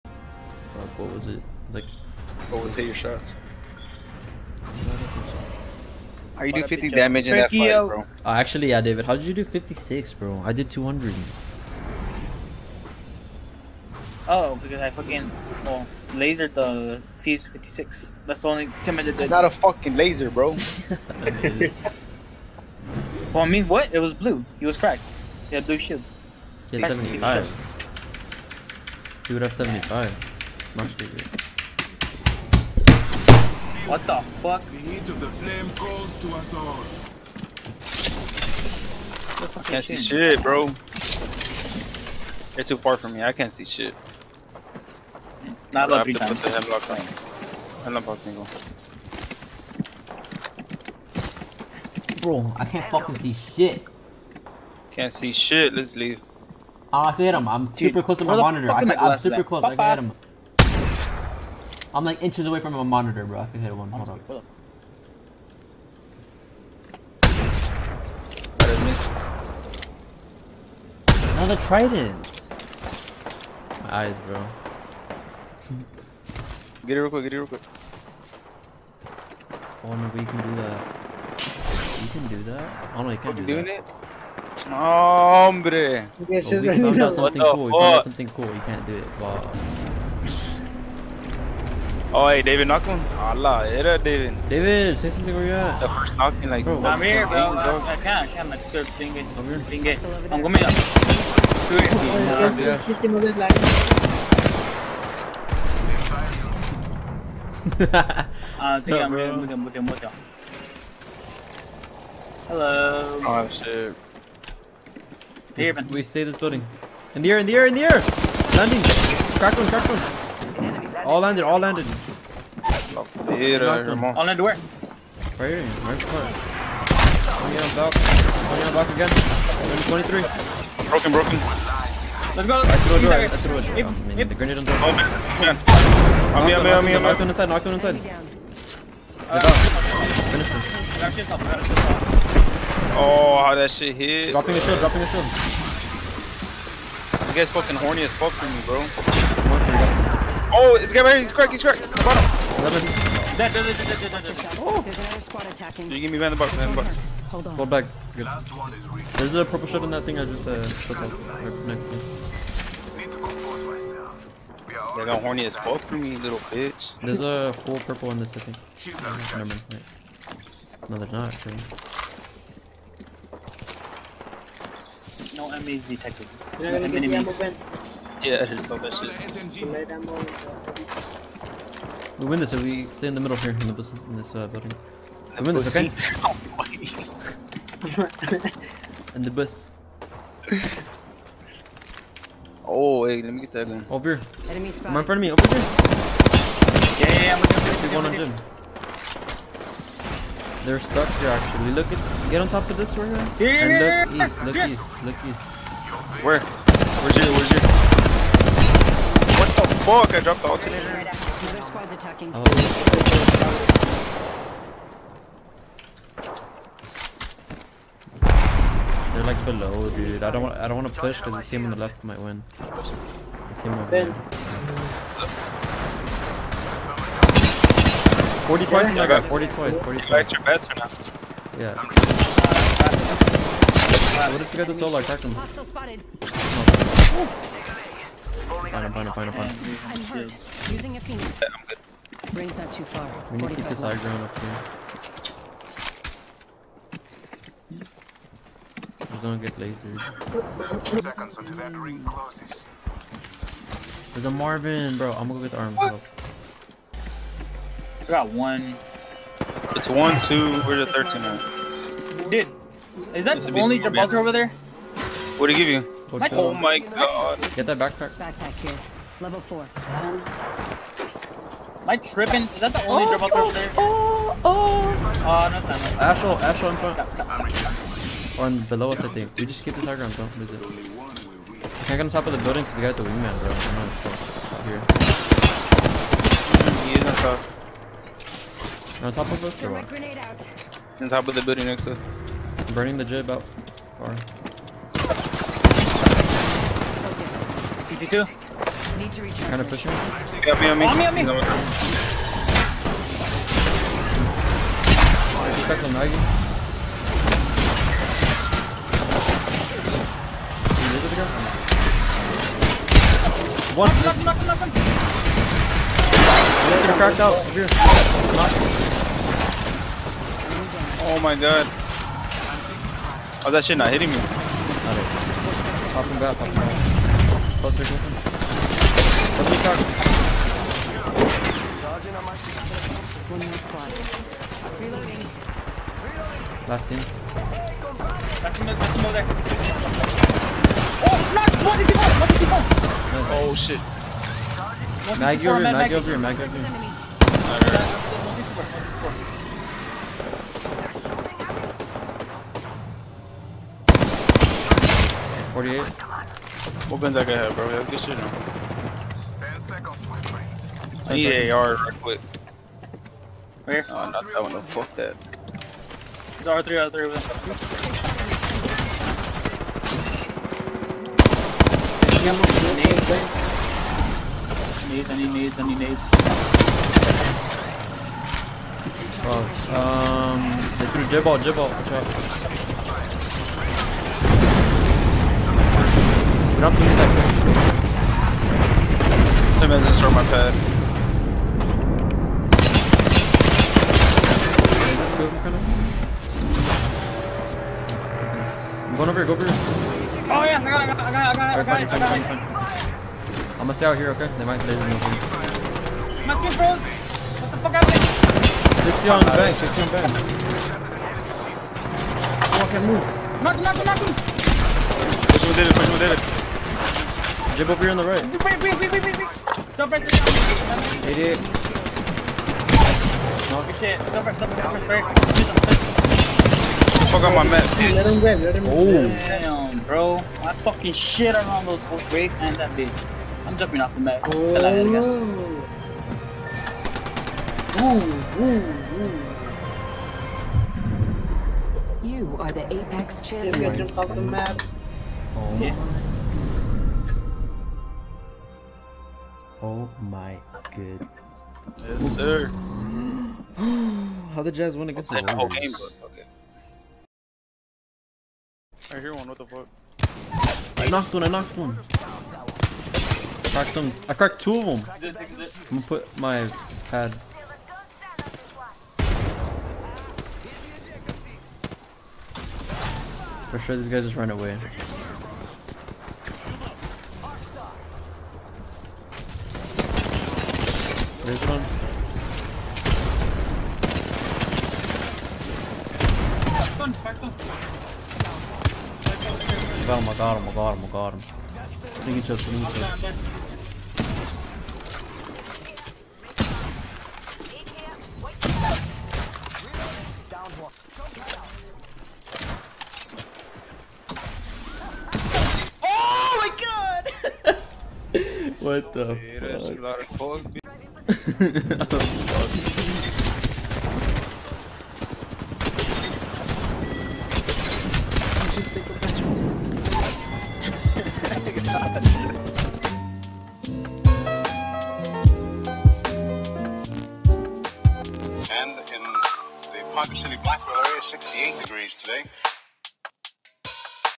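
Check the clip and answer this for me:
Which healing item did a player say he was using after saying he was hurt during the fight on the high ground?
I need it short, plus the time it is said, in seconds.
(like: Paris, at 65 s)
phoenix, at 240 s.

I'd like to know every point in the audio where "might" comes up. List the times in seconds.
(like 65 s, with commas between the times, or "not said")
222 s, 404 s.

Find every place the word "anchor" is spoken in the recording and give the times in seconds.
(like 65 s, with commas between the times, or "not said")
not said.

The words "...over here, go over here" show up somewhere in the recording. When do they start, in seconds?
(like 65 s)
399 s.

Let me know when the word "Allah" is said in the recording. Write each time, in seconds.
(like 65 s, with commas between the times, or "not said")
93 s.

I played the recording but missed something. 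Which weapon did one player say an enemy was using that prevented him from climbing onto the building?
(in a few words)
wingman.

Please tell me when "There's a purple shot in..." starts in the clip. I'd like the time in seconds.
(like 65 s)
159 s.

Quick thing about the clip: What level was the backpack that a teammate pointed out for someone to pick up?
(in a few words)
Level 4.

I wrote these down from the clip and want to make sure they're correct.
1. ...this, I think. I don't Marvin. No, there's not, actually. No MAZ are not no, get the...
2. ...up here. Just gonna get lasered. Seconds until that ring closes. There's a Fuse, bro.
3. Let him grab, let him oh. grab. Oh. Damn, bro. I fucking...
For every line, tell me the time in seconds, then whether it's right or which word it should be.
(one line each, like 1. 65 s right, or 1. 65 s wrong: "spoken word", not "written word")
1. 168 s wrong: "Wait", not "Marvin"
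2. 244 s wrong: "Marvin", not "Fuse"
3. 427 s right.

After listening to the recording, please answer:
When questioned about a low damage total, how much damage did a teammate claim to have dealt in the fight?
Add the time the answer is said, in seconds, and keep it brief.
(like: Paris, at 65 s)
200, at 10 s.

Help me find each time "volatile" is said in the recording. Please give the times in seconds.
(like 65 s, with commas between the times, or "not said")
not said.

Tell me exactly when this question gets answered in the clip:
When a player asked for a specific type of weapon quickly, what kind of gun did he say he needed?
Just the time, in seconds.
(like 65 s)
361 s.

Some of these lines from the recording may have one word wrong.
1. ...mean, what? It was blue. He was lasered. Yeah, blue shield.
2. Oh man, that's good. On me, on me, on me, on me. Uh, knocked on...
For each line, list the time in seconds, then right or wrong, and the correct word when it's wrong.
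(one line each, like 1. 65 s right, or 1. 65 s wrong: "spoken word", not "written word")
1. 23 s wrong: "cracked", not "lasered"
2. 134 s right.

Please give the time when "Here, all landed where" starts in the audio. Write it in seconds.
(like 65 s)
123 s.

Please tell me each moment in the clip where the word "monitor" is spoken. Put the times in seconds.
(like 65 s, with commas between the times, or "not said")
58 s, 62 s.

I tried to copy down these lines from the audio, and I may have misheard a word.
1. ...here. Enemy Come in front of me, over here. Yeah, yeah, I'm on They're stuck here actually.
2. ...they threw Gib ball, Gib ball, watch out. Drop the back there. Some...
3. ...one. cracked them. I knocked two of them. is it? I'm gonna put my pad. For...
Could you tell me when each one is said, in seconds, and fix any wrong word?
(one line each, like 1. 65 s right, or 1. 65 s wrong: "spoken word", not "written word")
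1. 194 s right
2. 380 s right
3. 461 s wrong: "cracked", not "knocked".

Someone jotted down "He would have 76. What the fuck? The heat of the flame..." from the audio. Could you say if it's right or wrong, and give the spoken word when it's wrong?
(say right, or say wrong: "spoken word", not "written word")
wrong: "75", not "76".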